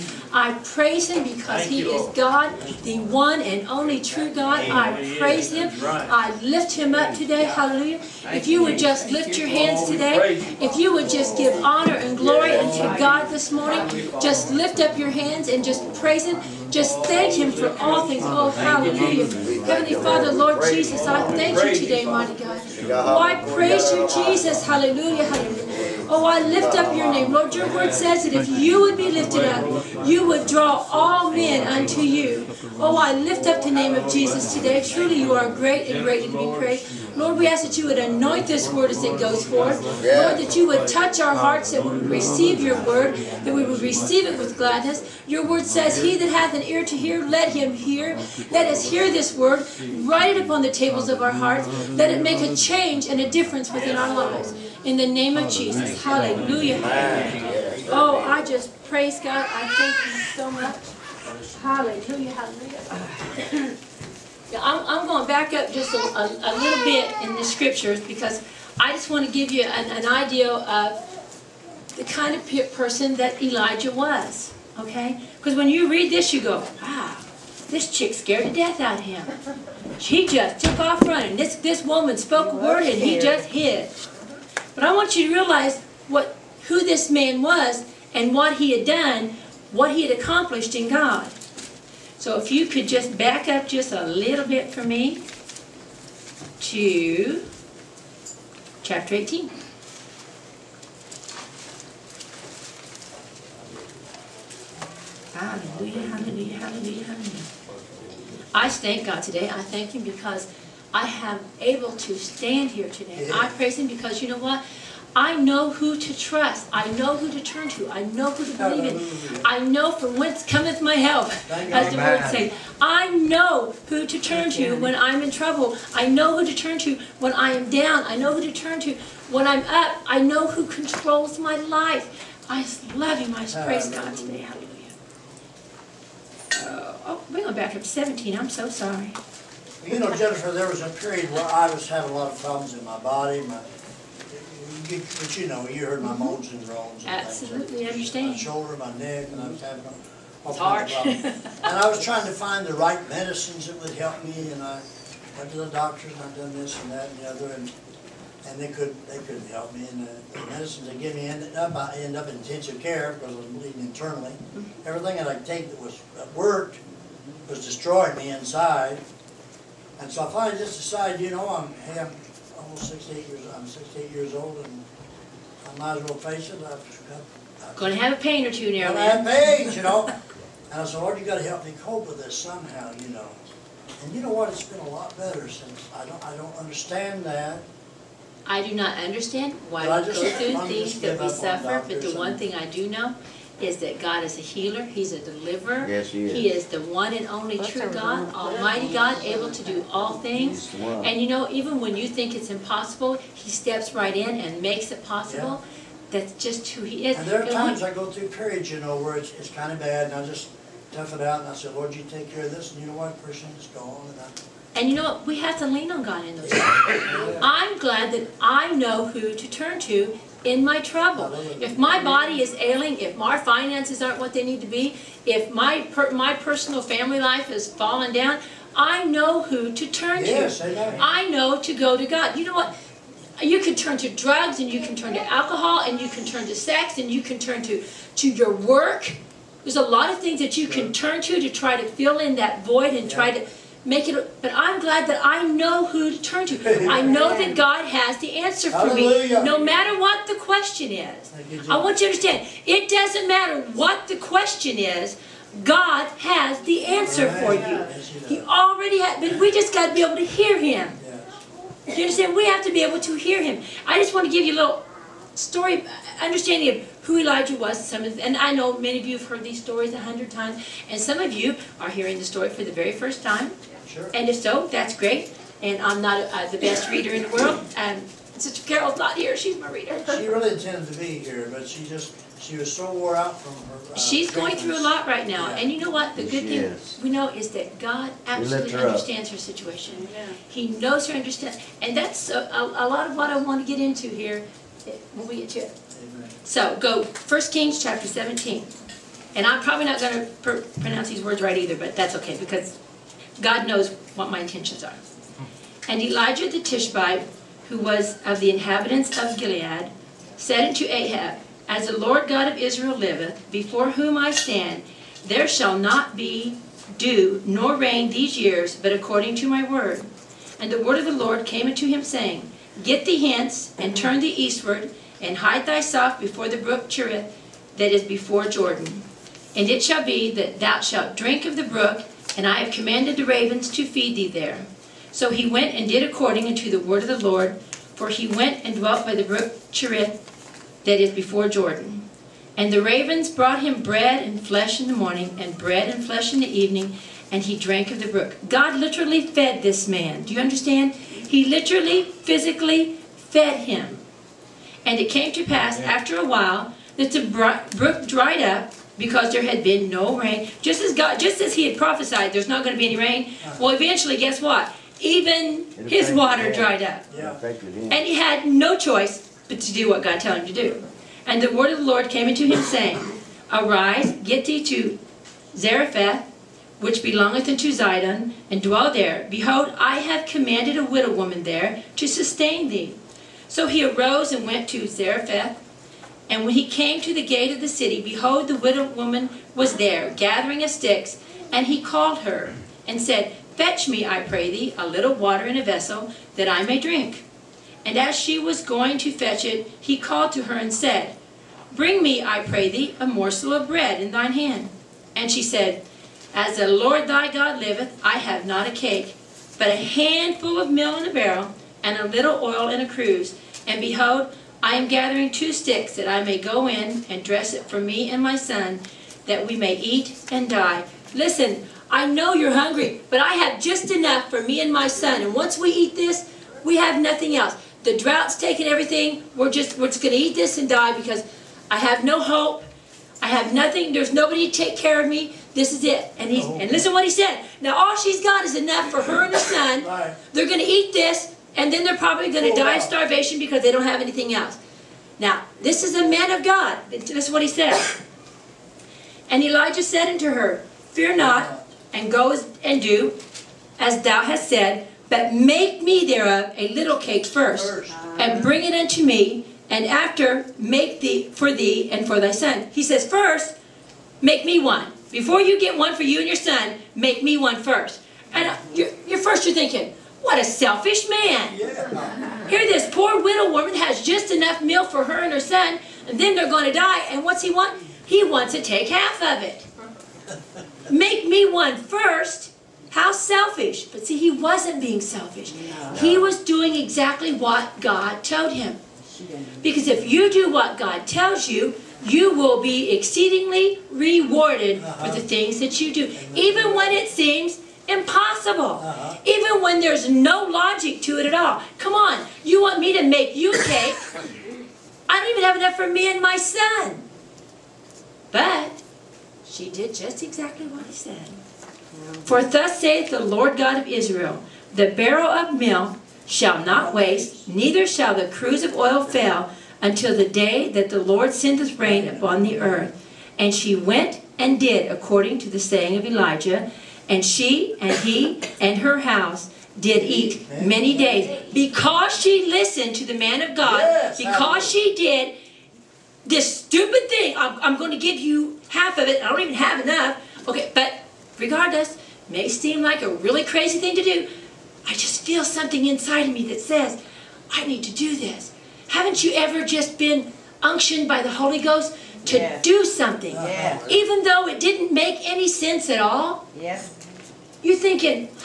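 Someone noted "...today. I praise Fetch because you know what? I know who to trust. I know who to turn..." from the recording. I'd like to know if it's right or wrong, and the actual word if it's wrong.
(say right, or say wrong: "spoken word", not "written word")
wrong: "Him", not "Fetch".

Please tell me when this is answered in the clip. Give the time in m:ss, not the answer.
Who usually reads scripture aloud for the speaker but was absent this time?
4:38.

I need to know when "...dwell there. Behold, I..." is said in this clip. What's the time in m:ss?
6:18.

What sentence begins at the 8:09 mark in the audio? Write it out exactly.
Because if you do what God tells you, you will be exceedingly rewarded uh -huh.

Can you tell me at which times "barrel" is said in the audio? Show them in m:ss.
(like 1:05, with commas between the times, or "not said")
6:51, 8:35.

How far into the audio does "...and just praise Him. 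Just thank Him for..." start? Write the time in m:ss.
0:15.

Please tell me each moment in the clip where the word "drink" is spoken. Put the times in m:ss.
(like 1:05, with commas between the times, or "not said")
5:31, 6:36.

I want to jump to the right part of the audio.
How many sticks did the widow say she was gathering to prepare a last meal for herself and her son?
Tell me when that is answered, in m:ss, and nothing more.
6:55.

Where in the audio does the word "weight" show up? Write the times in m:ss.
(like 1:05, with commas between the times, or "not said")
not said.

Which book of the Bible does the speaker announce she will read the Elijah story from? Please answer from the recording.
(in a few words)
First Kings.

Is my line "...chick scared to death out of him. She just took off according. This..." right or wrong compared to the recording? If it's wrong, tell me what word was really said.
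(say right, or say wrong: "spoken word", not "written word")
wrong: "running", not "according".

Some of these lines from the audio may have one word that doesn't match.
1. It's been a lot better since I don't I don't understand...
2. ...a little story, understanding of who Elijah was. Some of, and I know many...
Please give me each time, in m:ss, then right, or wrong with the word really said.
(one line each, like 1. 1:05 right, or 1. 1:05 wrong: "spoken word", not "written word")
1. 3:04 right
2. 4:24 right.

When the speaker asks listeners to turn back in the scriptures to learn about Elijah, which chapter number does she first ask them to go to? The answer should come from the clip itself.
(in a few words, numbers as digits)
18.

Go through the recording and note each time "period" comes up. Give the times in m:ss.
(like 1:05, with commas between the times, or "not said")
2:20, 3:28.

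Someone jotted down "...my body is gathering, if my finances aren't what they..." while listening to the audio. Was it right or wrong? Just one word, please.
wrong.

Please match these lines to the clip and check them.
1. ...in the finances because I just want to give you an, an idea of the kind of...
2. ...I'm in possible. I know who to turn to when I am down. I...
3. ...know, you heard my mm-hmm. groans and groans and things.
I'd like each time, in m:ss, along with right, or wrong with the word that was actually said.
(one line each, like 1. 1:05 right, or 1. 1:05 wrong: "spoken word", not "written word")
1. 1:07 wrong: "scriptures", not "finances"
2. 2:04 wrong: "trouble", not "possible"
3. 2:25 wrong: "moans", not "groans".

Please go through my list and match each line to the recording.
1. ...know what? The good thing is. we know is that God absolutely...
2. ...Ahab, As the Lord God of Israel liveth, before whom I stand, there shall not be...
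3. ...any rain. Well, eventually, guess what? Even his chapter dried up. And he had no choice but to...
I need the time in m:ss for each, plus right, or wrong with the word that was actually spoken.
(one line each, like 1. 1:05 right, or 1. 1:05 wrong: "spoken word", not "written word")
1. 4:45 right
2. 5:10 right
3. 6:02 wrong: "water", not "chapter".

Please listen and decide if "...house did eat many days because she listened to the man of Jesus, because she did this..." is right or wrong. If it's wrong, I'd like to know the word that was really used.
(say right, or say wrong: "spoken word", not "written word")
wrong: "God", not "Jesus".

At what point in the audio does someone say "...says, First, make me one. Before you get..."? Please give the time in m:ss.
7:42.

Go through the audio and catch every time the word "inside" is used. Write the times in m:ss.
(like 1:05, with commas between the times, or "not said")
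2:48, 9:05.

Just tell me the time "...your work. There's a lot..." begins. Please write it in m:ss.
3:58.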